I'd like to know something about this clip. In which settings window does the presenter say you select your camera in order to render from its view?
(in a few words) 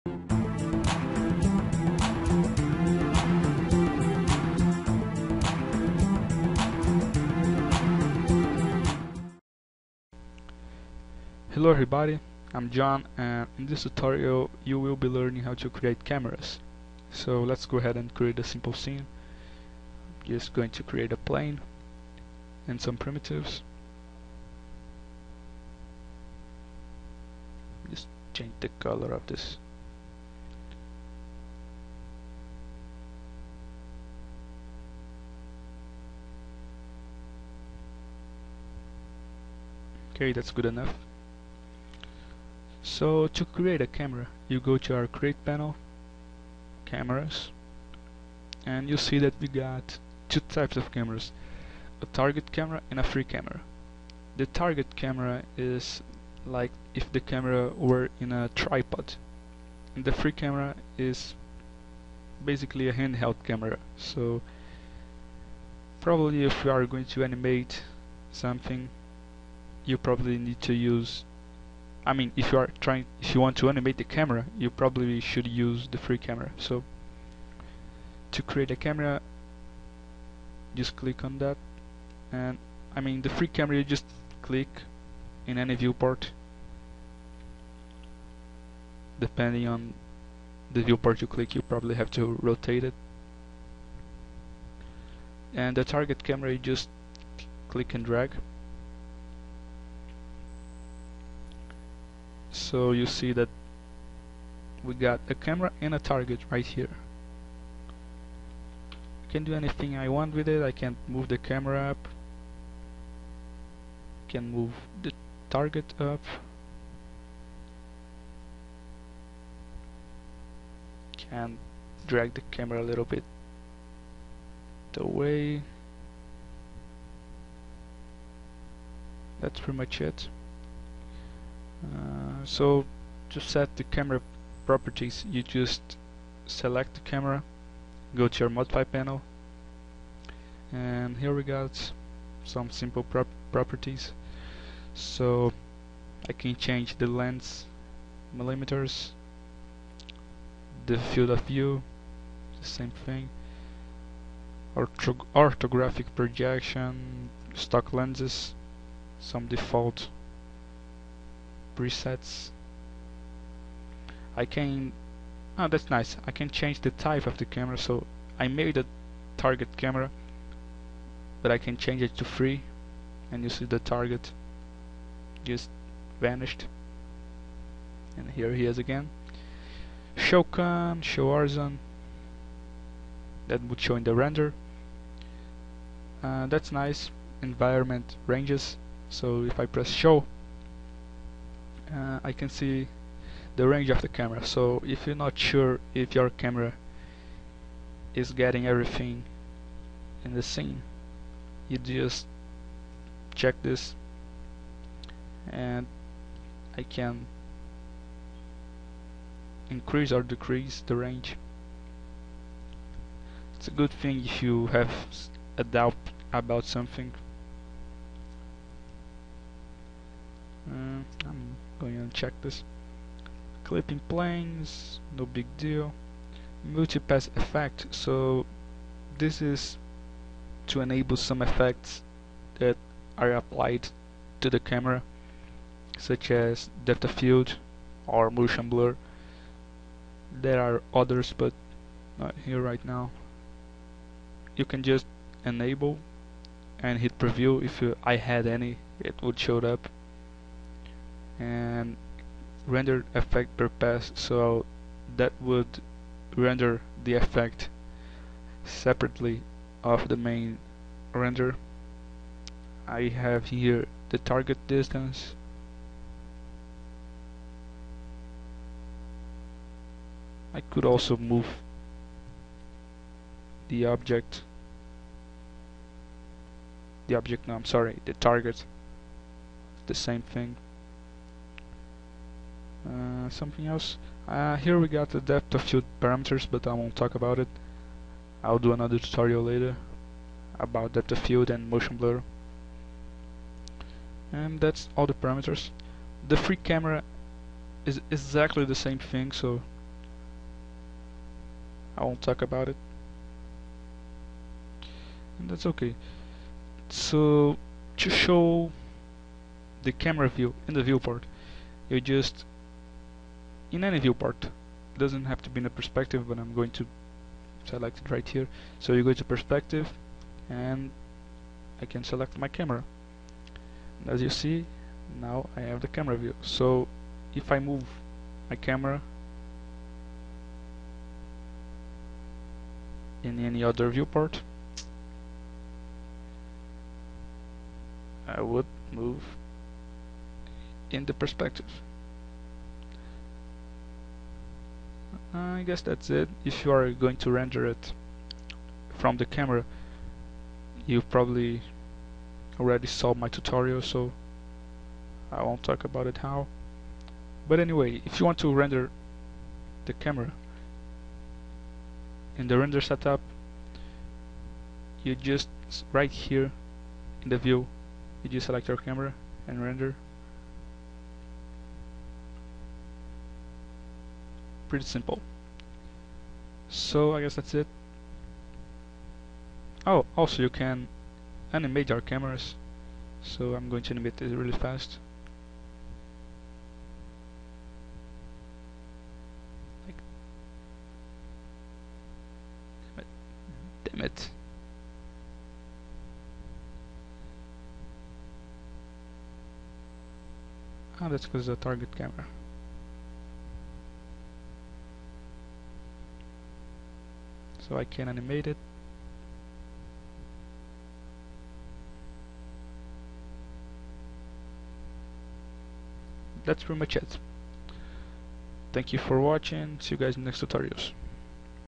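Render setup.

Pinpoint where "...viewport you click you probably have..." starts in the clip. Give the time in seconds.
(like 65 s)
90 s.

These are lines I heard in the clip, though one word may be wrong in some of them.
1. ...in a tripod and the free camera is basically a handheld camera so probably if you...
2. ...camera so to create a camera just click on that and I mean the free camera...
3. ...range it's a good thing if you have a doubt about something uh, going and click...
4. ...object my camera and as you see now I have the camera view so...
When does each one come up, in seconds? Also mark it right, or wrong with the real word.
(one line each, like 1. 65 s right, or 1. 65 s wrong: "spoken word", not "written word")
1. 58 s right
2. 76 s right
3. 210 s wrong: "check", not "click"
4. 322 s wrong: "select", not "object".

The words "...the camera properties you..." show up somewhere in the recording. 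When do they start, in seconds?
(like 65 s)
133 s.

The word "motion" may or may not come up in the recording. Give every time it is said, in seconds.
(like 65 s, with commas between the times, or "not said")
238 s, 291 s.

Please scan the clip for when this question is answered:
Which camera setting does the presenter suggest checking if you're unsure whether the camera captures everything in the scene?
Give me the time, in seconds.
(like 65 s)
187 s.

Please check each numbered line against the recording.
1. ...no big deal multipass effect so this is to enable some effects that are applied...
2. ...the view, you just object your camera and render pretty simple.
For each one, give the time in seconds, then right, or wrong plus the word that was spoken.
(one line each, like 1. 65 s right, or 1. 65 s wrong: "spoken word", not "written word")
1. 225 s right
2. 367 s wrong: "select", not "object".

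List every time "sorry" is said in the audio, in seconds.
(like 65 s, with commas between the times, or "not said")
277 s.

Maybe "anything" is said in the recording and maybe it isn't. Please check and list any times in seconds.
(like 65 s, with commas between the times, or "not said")
109 s.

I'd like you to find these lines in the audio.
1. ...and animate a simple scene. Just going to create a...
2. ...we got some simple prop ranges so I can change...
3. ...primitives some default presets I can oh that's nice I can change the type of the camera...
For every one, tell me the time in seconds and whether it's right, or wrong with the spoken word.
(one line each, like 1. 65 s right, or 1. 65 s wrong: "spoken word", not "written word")
1. 17 s wrong: "create", not "animate"
2. 141 s wrong: "properties", not "ranges"
3. 157 s wrong: "lenses", not "primitives".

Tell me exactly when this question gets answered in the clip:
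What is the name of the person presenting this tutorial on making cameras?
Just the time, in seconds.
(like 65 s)
12 s.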